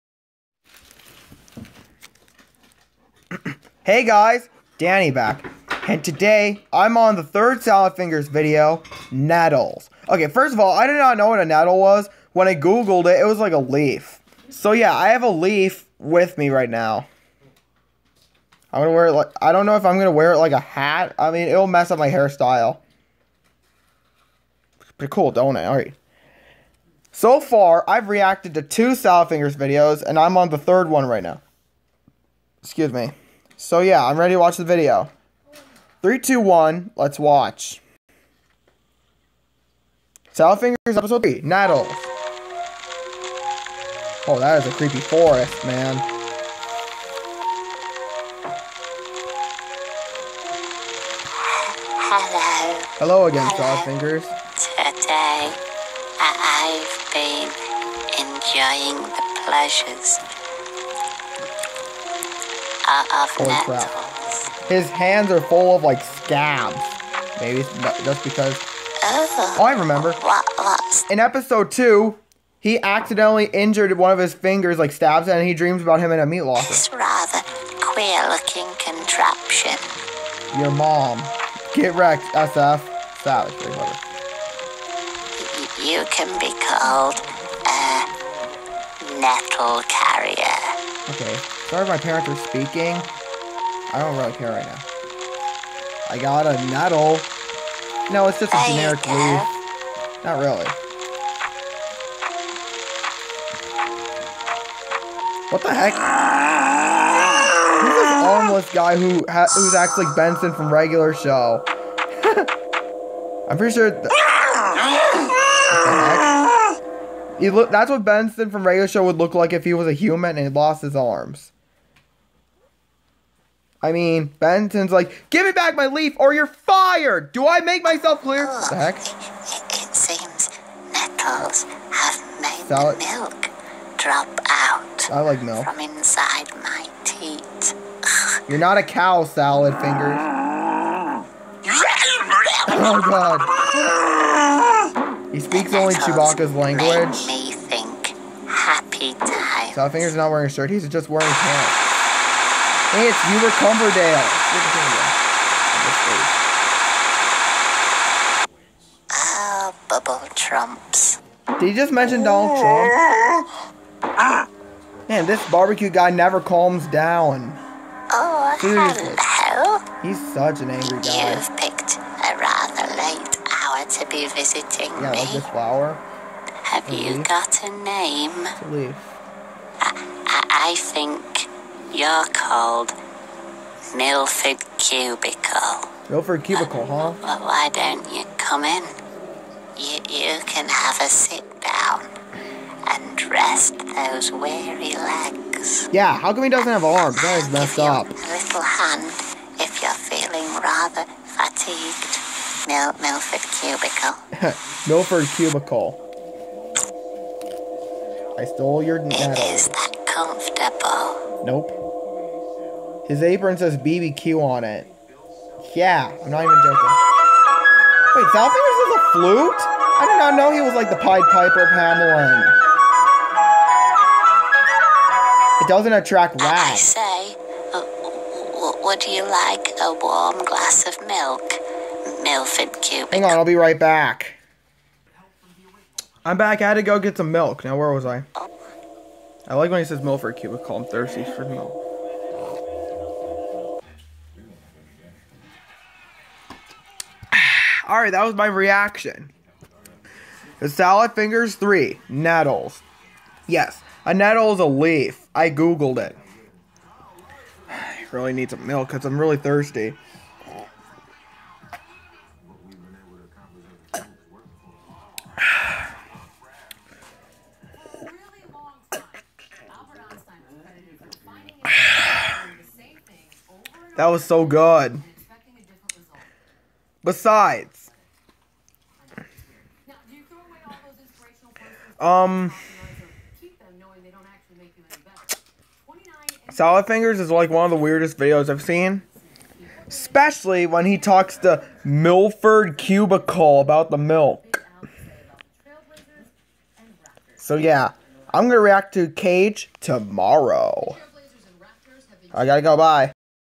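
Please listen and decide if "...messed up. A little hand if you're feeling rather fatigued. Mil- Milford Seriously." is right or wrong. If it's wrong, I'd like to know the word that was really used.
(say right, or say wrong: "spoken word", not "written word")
wrong: "Cubicle", not "Seriously".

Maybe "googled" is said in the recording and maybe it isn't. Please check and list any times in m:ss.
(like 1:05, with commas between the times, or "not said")
0:12, 4:15.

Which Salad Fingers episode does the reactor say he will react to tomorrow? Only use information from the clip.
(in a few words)
Cage.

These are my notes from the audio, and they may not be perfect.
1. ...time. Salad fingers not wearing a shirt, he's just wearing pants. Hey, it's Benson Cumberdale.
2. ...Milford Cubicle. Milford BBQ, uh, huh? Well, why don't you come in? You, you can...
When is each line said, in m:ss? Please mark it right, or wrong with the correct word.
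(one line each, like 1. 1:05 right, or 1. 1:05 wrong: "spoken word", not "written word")
1. 2:29 wrong: "Hubert", not "Benson"
2. 3:03 wrong: "Cubicle", not "BBQ".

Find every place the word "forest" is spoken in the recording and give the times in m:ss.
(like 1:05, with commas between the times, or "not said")
0:44.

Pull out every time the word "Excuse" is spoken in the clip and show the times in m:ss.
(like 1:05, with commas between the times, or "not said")
0:32.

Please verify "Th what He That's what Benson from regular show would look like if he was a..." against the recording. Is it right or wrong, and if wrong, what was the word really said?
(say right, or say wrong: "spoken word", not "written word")
right.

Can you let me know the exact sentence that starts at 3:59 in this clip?
I like when he says "milk Milford Cubicle.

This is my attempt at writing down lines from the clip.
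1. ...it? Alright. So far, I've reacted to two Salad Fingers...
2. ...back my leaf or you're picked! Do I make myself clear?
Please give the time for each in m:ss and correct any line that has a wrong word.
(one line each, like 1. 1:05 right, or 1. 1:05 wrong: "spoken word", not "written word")
1. 0:25 right
2. 2:05 wrong: "fired", not "picked".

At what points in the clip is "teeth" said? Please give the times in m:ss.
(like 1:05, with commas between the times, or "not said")
2:17.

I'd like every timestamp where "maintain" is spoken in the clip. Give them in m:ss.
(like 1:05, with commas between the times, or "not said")
not said.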